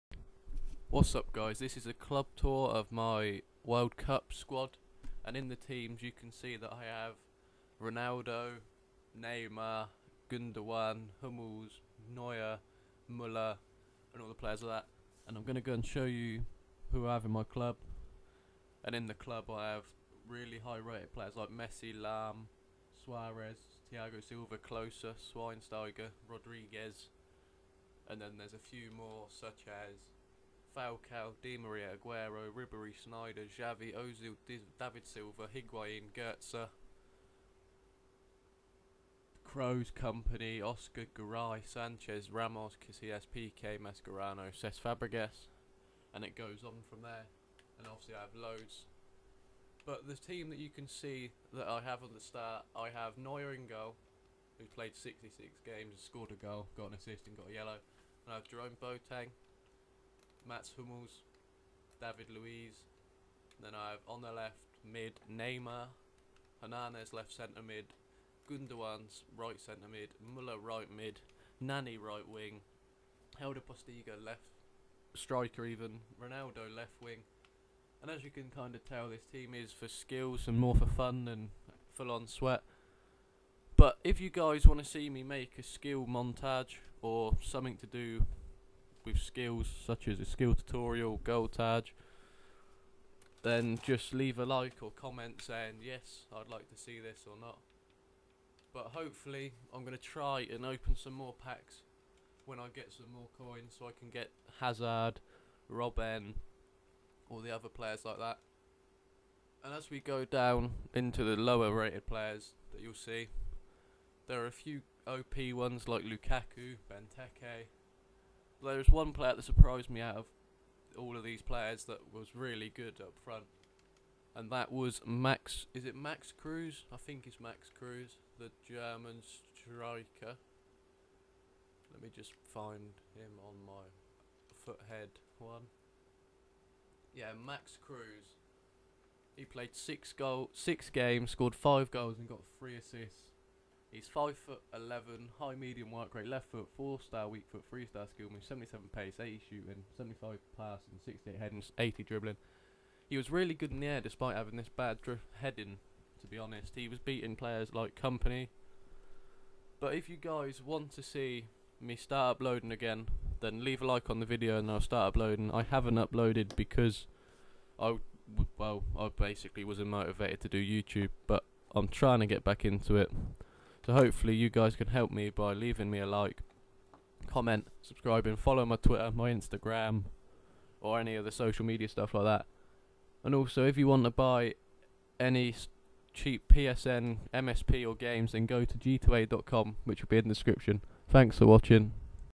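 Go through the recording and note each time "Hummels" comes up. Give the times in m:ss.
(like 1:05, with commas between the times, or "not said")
0:11, 1:00.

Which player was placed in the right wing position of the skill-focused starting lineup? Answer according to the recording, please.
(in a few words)
Nani.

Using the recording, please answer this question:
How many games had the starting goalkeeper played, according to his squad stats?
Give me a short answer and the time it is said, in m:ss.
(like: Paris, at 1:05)
66, at 0:54.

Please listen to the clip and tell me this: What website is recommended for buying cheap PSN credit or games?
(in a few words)
g2a.com.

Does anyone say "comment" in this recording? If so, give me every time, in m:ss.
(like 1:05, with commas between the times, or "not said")
1:34, 2:57.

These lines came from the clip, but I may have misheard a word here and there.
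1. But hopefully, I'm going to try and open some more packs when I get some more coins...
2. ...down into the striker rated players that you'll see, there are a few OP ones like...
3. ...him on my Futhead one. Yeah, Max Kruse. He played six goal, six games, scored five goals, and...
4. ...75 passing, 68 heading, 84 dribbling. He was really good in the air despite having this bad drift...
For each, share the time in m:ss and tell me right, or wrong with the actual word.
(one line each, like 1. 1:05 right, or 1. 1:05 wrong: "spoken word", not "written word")
1. 1:38 right
2. 1:50 wrong: "lower", not "striker"
3. 2:13 right
4. 2:29 wrong: "80", not "84".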